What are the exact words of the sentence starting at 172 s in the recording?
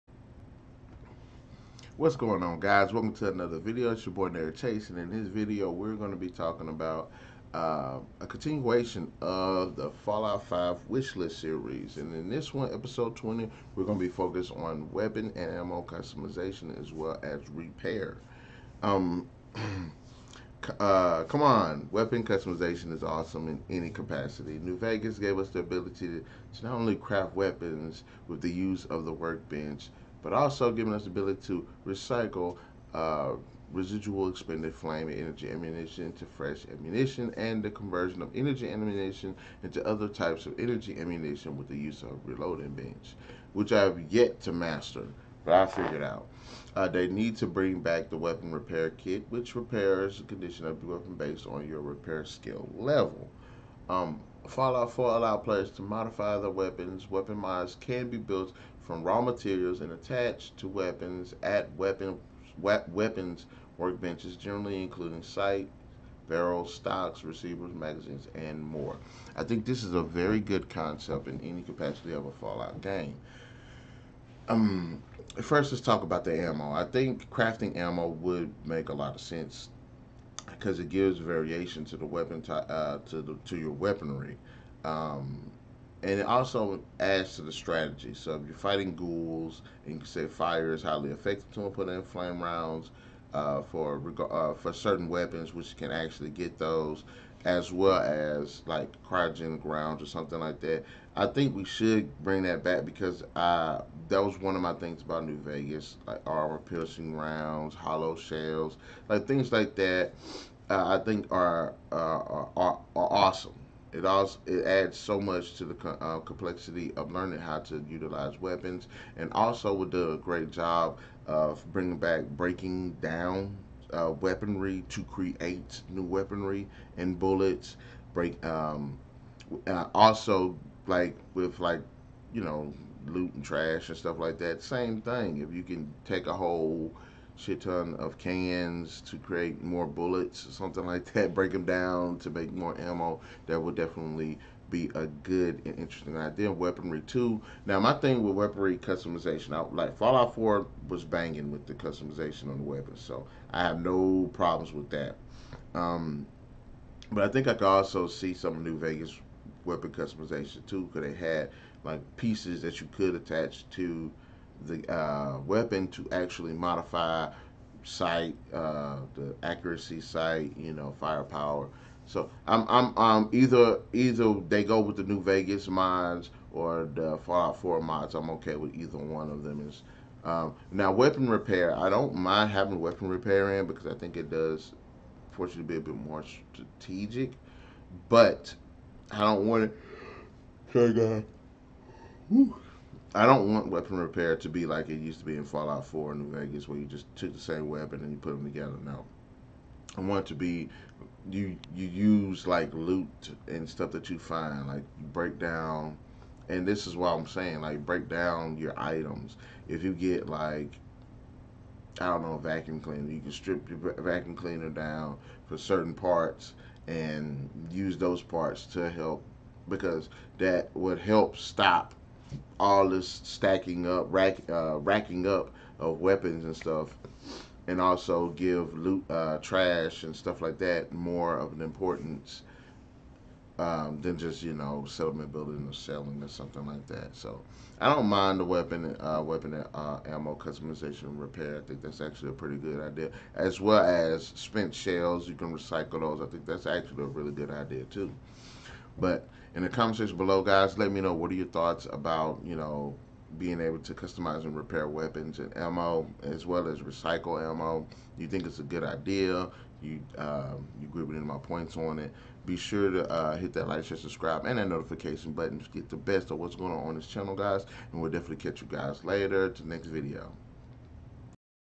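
So I'm I'm um either either they go with the New Vegas mods or the Fallout 4 mods.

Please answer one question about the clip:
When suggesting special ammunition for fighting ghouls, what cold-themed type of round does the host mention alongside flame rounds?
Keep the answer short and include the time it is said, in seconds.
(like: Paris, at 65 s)
cryogenic rounds, at 99 s.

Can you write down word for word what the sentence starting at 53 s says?
Um, Fallout 4 allow players to modify their weapons.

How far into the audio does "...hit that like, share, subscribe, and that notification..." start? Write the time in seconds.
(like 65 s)
263 s.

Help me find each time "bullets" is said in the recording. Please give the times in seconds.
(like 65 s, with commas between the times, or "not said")
127 s, 139 s.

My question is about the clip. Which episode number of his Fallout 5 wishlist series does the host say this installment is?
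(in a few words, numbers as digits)
20.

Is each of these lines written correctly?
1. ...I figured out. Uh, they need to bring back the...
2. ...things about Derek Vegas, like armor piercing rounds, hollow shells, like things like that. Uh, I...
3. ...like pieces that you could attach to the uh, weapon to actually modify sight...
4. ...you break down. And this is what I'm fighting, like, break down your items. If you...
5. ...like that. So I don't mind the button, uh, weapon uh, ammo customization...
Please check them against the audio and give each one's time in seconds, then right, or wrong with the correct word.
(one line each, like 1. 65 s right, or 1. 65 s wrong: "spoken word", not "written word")
1. 45 s right
2. 104 s wrong: "New", not "Derek"
3. 161 s right
4. 204 s wrong: "saying", not "fighting"
5. 236 s wrong: "weapon", not "button".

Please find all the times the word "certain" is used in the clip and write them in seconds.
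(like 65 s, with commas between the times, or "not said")
94 s, 215 s.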